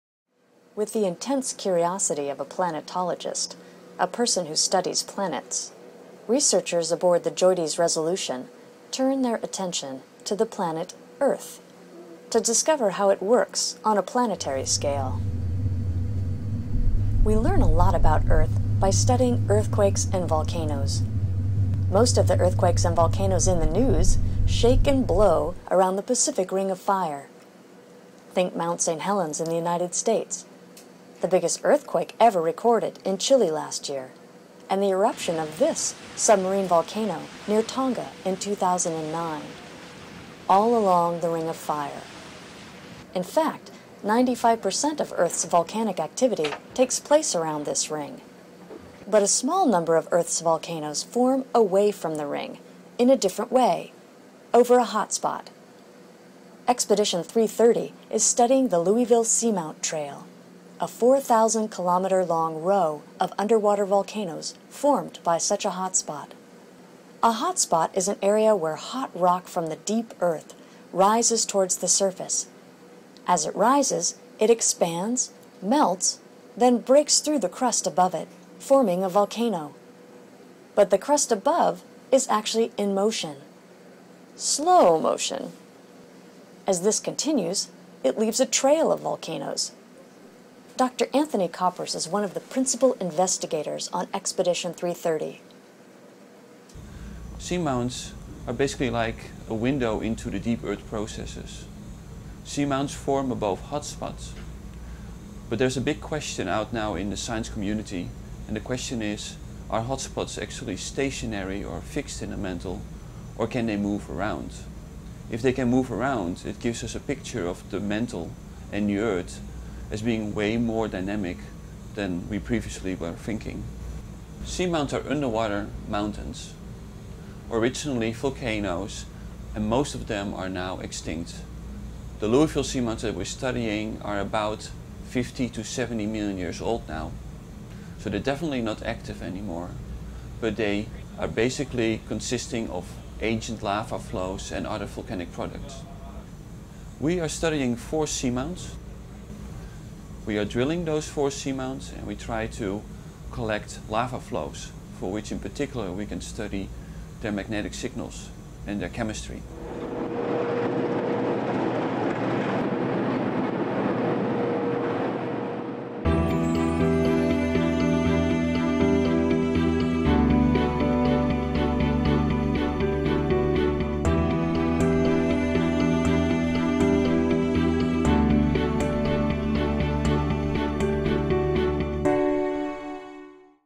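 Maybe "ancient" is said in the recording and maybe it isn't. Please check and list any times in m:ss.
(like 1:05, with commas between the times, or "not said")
2:23.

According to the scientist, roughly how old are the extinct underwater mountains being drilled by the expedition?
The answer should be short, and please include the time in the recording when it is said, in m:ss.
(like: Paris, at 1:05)
50 to 70 million years, at 2:15.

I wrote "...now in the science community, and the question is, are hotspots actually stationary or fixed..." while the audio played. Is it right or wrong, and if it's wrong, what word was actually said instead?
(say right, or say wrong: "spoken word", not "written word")
right.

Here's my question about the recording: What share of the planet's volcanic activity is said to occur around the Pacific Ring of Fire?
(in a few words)
95%.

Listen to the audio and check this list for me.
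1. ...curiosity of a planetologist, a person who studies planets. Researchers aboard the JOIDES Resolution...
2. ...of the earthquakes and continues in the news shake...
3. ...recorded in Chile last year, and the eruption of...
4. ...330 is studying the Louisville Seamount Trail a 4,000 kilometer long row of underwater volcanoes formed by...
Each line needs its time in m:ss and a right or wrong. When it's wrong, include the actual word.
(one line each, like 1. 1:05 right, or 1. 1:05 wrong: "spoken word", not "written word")
1. 0:01 right
2. 0:22 wrong: "volcanoes", not "continues"
3. 0:32 right
4. 0:57 right.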